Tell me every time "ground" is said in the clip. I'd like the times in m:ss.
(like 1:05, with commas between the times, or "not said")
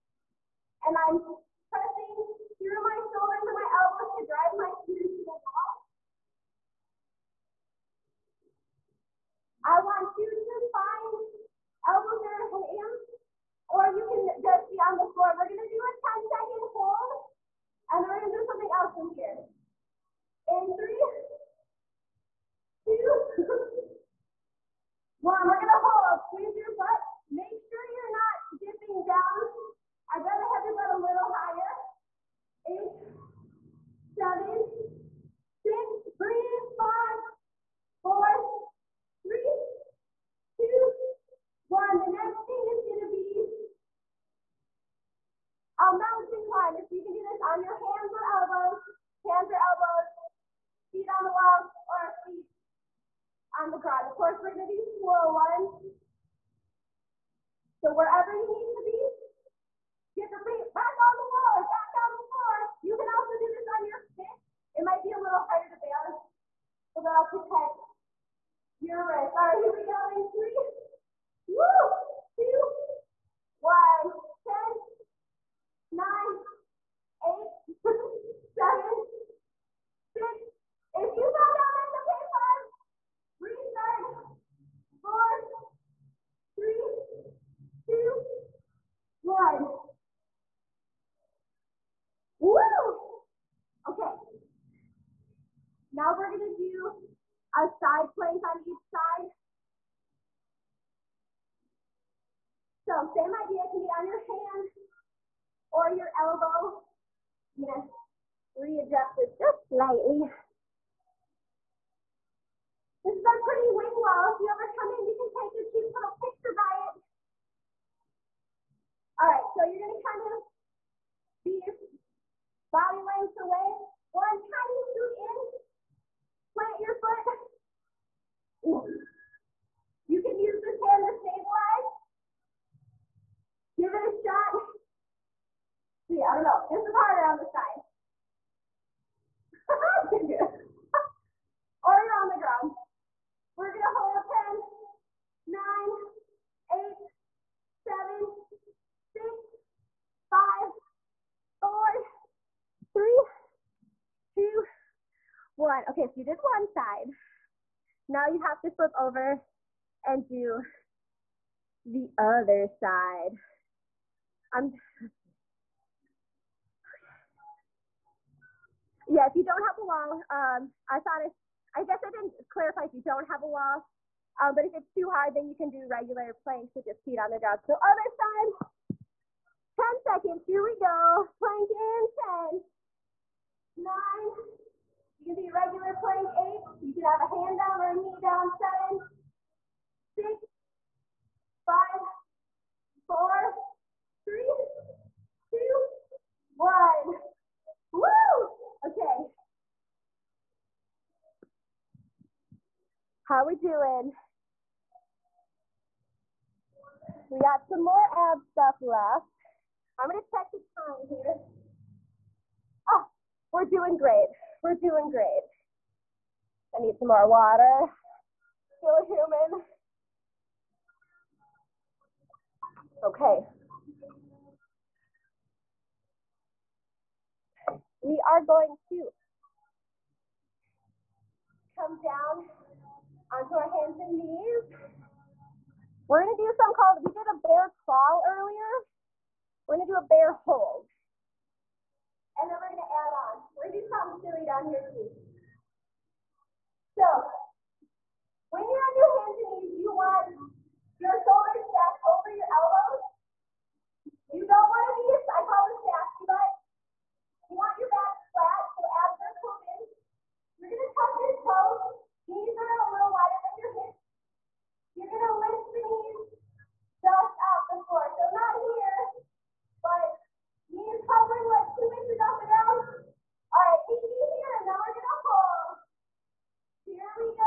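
0:53, 2:22, 2:57, 4:32.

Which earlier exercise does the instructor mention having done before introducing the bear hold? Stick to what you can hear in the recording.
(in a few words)
Bear crawl.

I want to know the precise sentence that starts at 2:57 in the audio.
So other side, 10 seconds, here we go.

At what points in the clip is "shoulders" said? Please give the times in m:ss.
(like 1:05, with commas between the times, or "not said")
0:03, 4:11.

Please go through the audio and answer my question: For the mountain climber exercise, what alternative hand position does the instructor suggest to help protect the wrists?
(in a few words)
On your fist.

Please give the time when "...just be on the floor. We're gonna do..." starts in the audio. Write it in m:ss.
0:14.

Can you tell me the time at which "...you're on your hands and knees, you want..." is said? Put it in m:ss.
4:08.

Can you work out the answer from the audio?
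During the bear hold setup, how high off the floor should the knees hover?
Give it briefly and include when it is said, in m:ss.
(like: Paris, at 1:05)
2 inches, at 4:31.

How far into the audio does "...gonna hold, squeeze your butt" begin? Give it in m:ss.
0:25.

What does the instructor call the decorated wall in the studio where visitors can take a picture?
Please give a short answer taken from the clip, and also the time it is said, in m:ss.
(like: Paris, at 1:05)
Pretty wing wall, at 1:53.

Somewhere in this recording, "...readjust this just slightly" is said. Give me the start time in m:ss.
1:48.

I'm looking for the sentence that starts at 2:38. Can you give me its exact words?
Now you have to flip over and do the other side.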